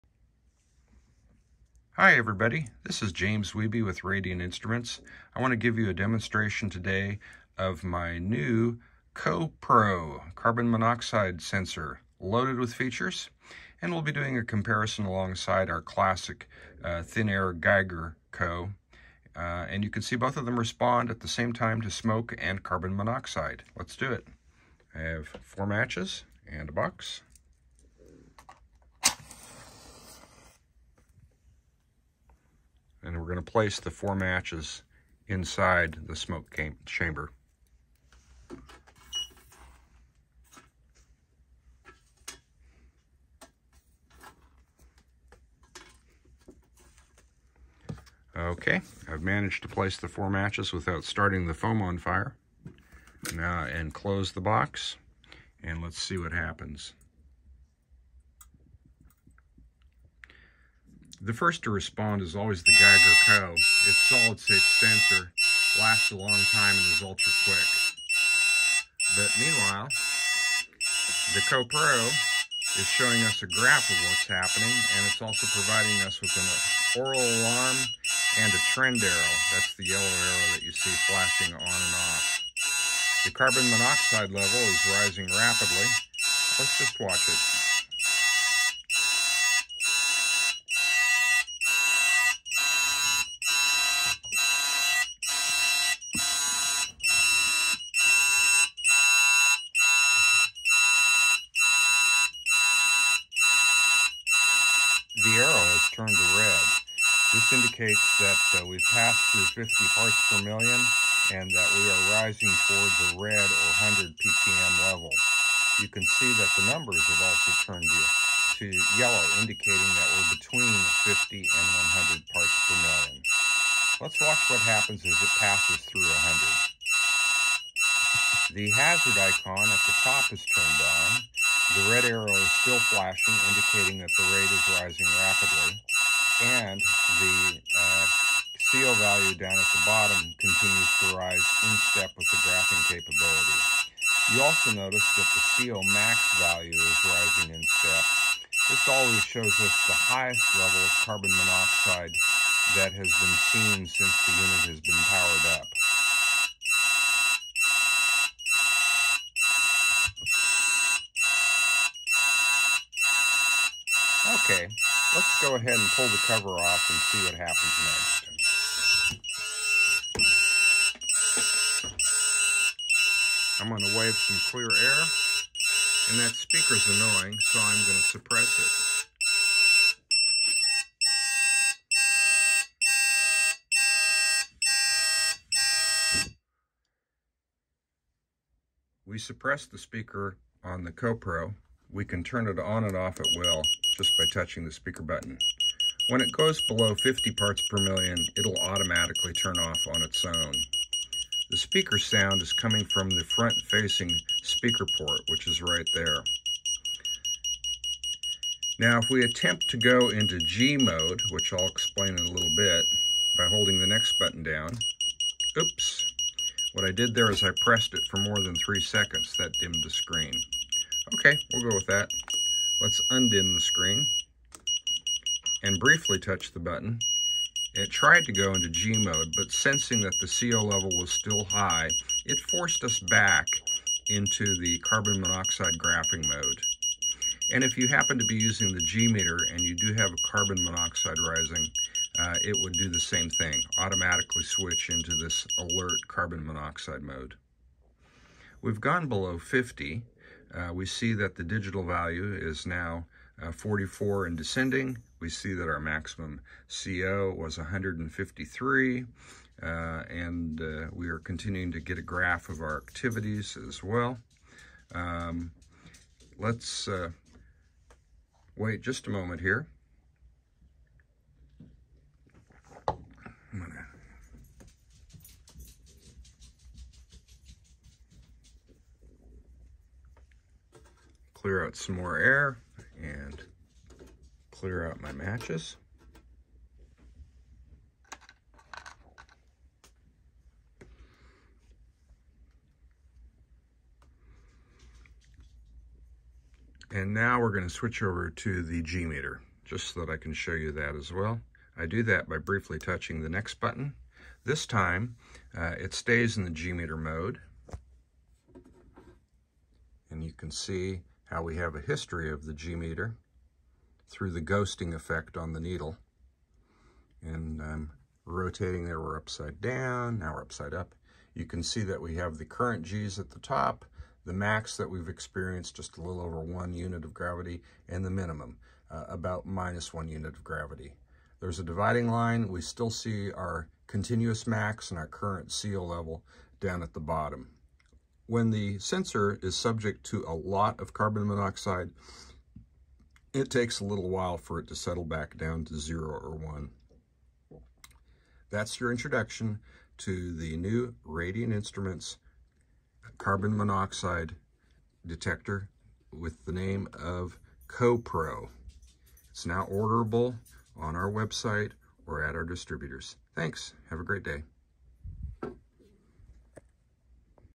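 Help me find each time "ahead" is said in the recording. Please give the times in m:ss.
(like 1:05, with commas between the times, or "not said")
2:45.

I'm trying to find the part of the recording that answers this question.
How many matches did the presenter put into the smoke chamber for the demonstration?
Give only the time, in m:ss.
0:33.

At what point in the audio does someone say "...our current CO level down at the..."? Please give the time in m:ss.
5:34.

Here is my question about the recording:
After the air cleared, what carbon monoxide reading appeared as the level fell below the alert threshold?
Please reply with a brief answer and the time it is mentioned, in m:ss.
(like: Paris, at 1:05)
44, at 4:13.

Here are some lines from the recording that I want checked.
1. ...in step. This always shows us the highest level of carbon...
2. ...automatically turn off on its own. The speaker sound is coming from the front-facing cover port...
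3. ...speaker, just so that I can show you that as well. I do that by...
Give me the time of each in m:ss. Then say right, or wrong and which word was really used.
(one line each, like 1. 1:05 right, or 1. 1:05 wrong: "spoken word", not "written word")
1. 2:27 right
2. 3:18 wrong: "speaker", not "cover"
3. 4:59 wrong: "meter", not "speaker".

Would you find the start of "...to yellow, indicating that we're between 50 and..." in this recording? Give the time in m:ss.
1:58.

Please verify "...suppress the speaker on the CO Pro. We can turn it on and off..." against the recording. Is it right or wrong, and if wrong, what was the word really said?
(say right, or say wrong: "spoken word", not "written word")
right.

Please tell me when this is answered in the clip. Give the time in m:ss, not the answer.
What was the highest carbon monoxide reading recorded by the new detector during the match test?
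4:17.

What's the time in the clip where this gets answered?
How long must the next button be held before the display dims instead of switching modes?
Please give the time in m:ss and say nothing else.
3:38.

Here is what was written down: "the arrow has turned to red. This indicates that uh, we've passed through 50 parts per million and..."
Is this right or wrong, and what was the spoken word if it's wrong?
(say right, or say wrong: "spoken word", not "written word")
right.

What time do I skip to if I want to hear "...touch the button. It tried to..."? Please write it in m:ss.
3:46.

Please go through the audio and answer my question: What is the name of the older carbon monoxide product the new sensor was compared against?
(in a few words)
Thin Air Geiger Co.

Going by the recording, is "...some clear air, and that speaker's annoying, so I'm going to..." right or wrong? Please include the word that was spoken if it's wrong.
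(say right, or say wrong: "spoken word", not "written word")
right.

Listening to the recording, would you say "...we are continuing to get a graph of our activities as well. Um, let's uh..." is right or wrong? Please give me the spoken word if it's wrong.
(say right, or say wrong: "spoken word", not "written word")
right.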